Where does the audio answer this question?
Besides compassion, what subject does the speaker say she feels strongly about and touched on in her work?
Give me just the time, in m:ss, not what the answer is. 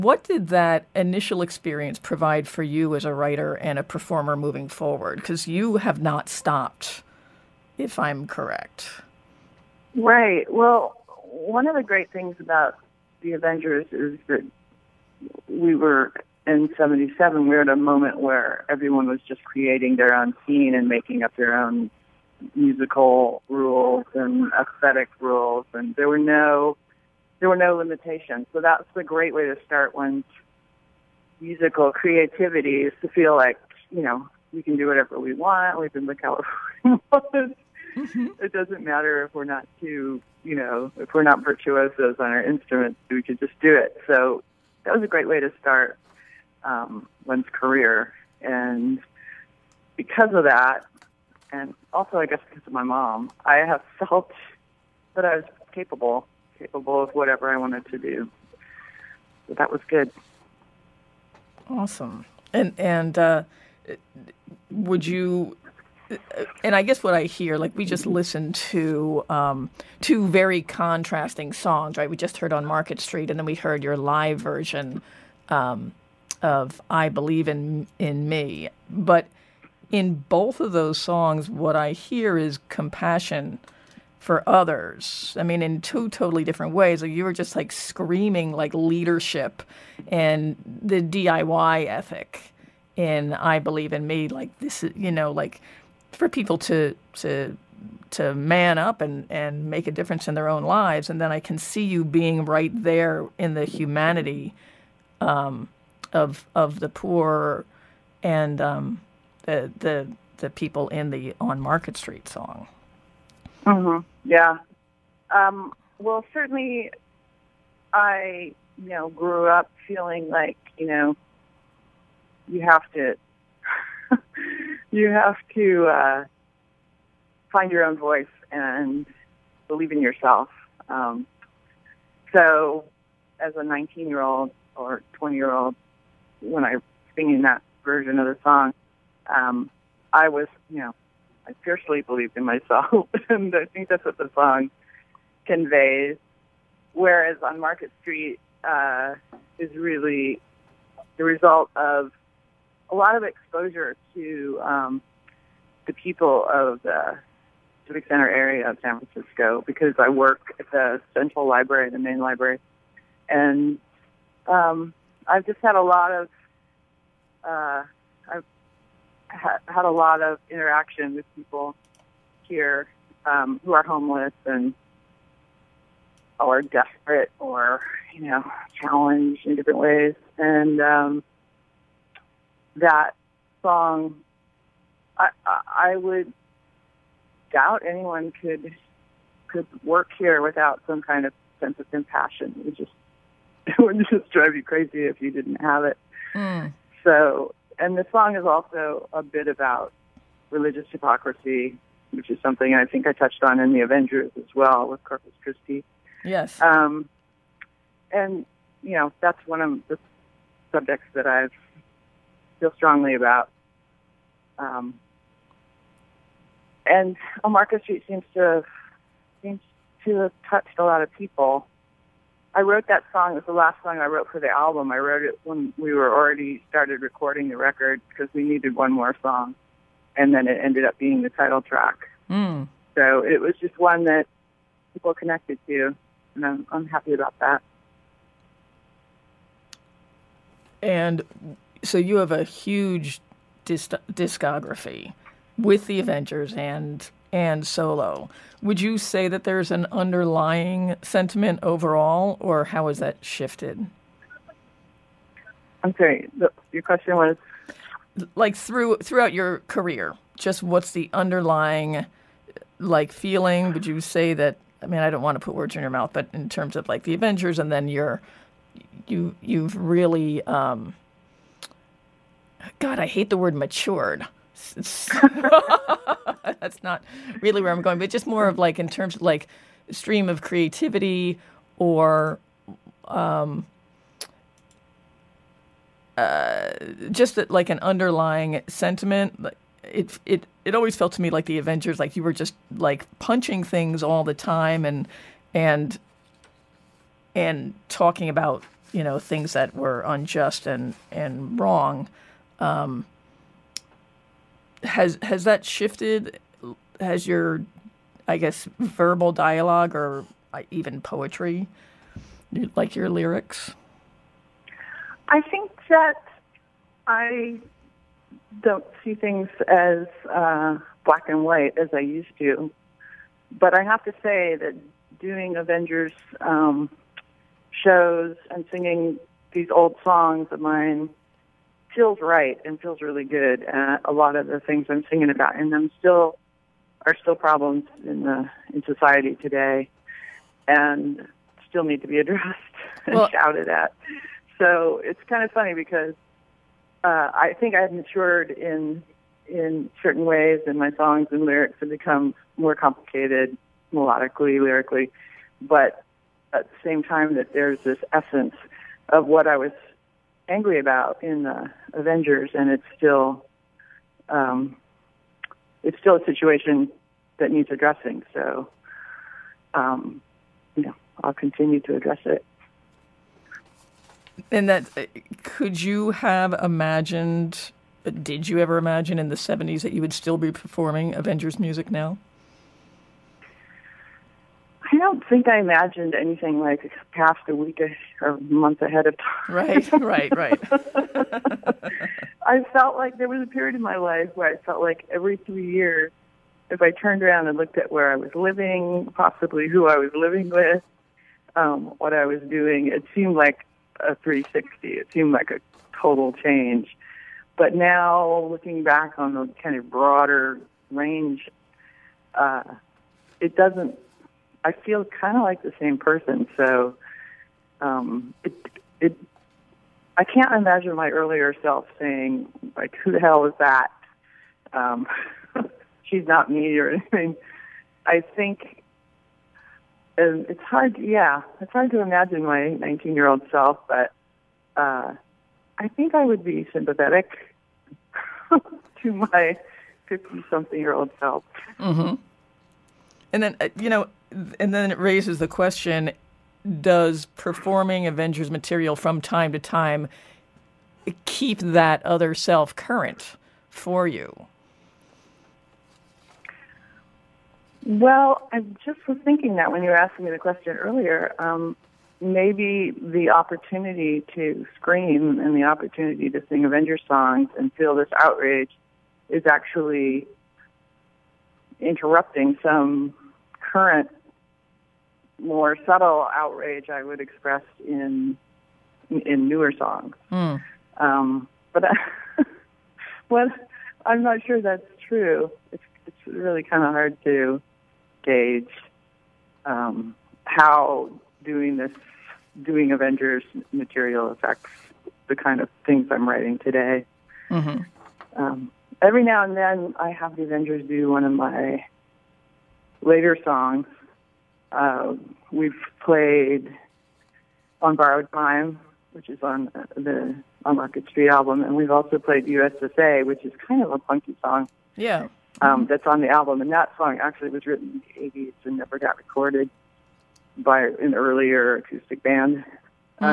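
3:20.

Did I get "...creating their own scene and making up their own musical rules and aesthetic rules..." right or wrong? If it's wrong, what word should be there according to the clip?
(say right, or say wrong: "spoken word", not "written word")
right.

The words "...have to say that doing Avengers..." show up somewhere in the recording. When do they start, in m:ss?
5:23.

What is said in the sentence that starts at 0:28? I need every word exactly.
So that's a great way to start one's musical creativity is to feel like you know we can do whatever we want.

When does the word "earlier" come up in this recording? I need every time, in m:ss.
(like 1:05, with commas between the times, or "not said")
7:01, 7:40, 8:41.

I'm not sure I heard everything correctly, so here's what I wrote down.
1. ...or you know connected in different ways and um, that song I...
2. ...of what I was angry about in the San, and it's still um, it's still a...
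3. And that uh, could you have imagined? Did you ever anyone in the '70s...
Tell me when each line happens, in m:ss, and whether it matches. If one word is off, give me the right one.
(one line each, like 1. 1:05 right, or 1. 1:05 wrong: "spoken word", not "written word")
1. 2:57 wrong: "challenged", not "connected"
2. 5:59 wrong: "Avengers", not "San"
3. 6:14 wrong: "imagine", not "anyone".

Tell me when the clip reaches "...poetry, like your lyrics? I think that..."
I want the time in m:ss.
5:11.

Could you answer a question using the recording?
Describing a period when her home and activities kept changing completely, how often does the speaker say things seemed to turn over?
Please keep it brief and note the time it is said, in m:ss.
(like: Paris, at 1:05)
every 3 years, at 6:35.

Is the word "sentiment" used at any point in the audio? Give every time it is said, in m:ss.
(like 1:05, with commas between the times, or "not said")
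4:11, 4:48.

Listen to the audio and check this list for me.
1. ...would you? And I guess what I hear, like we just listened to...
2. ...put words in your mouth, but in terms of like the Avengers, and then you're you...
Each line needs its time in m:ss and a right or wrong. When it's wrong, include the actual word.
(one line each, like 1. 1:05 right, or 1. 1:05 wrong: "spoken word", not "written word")
1. 1:04 right
2. 4:25 right.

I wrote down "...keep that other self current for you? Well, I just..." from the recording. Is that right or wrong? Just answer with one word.
right.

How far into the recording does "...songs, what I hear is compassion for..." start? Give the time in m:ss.
1:20.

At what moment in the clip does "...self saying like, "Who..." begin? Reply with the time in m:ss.
7:01.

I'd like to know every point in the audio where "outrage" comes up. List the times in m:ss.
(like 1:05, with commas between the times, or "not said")
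7:48, 7:56.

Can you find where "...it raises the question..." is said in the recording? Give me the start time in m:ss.
7:24.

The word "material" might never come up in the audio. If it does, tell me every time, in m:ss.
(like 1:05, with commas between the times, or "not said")
7:28, 8:13.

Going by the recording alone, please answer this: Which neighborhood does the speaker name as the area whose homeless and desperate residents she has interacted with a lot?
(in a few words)
Civic Center.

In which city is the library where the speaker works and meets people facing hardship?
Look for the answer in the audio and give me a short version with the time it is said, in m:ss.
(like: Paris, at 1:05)
San Francisco, at 2:38.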